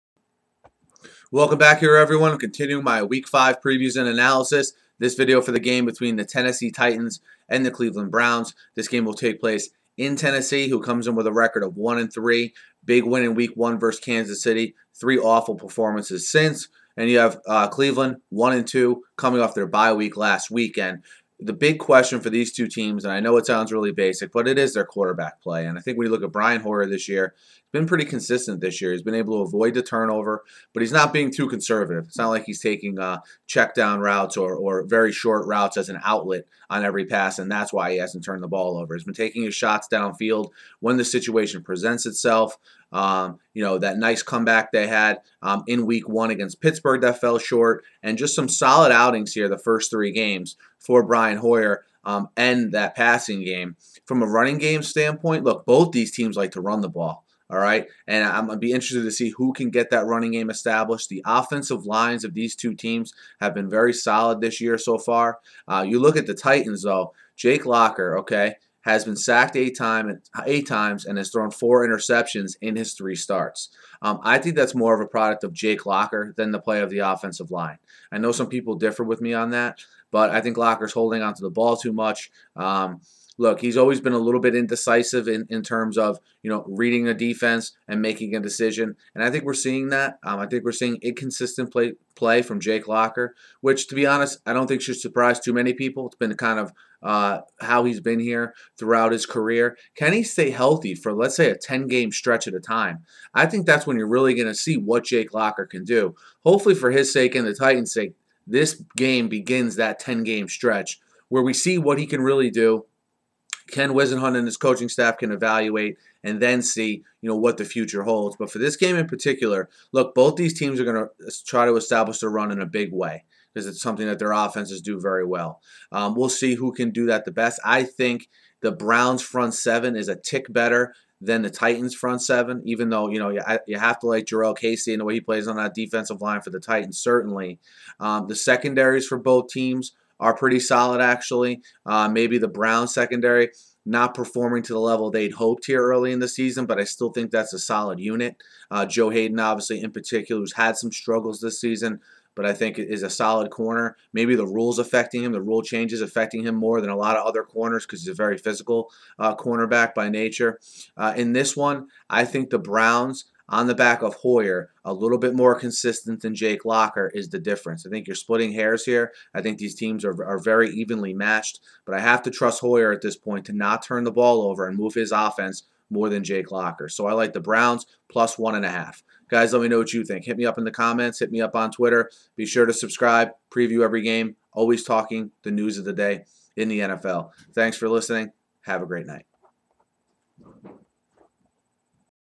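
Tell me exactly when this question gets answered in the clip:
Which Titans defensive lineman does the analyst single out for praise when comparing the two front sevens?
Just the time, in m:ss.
2:14.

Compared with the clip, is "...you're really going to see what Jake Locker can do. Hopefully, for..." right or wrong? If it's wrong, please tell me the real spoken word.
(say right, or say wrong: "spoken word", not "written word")
right.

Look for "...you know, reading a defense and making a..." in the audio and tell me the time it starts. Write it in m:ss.
1:26.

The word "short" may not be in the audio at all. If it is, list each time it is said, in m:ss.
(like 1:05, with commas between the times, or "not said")
0:35, 0:47.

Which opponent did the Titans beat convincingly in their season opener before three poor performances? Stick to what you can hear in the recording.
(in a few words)
Kansas City.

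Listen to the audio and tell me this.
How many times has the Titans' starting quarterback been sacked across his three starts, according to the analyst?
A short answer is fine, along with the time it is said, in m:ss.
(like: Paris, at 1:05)
8, at 1:10.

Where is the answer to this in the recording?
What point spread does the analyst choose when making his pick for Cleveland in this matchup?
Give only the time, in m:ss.
2:58.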